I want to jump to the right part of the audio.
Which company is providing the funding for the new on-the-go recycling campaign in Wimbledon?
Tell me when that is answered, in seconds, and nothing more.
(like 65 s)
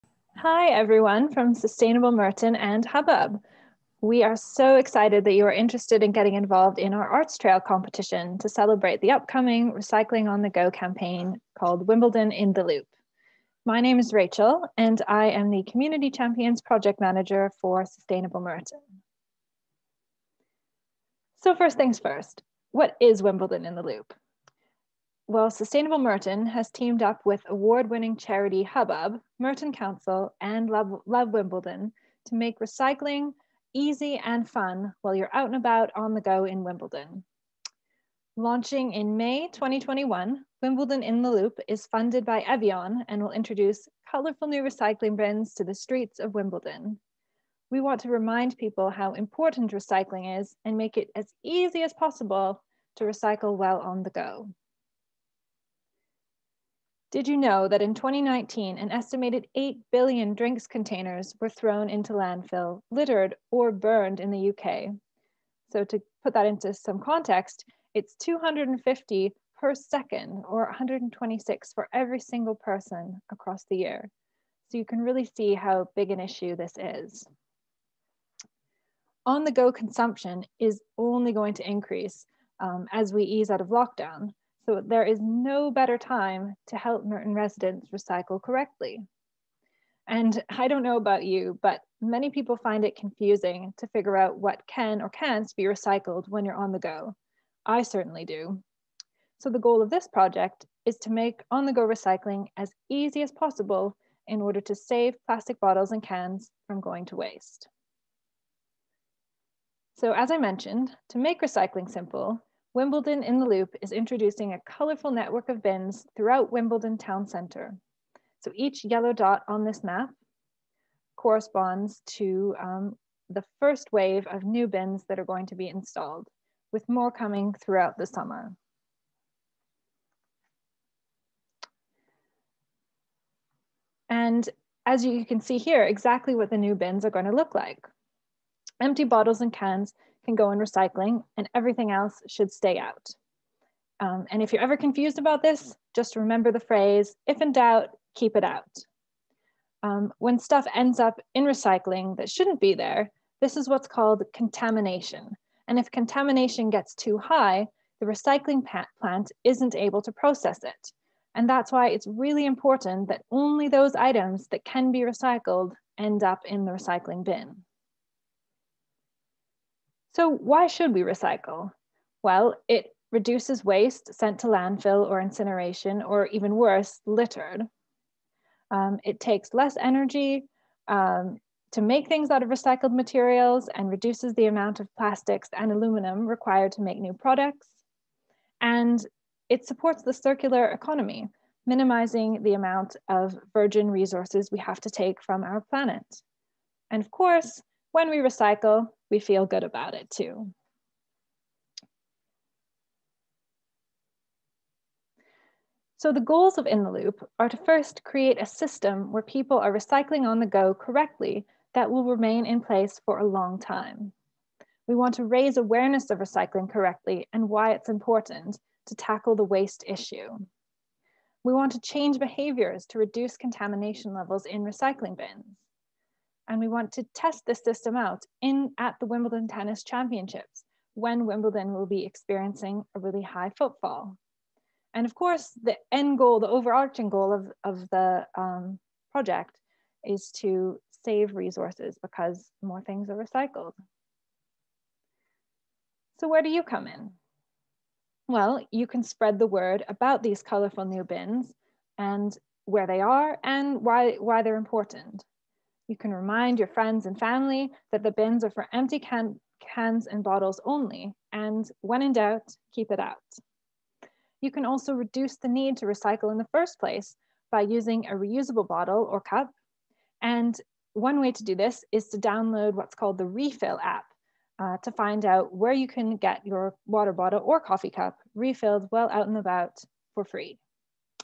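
42 s.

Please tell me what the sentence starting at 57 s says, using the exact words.
Did you know that in 2019, an estimated 8 billion drinks containers were thrown into landfill, littered, or burned in the UK?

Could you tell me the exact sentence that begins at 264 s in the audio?
You can also reduce the need to recycle in the first place by using a reusable bottle or cup.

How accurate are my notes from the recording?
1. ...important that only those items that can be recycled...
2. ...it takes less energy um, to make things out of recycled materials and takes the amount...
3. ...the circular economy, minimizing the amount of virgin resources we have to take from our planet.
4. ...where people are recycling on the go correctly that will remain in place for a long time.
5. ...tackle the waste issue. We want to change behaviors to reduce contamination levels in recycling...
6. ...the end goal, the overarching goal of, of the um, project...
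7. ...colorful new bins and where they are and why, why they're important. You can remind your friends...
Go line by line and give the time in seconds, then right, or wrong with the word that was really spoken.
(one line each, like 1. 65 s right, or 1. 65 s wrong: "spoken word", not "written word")
1. 162 s right
2. 179 s wrong: "reduces", not "takes"
3. 190 s right
4. 209 s right
5. 218 s right
6. 235 s right
7. 250 s right.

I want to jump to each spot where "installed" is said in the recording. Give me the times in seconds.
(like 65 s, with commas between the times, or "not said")
125 s.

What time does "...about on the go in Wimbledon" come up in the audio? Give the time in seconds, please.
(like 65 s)
35 s.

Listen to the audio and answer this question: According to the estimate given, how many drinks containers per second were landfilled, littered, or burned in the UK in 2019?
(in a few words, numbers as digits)
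250.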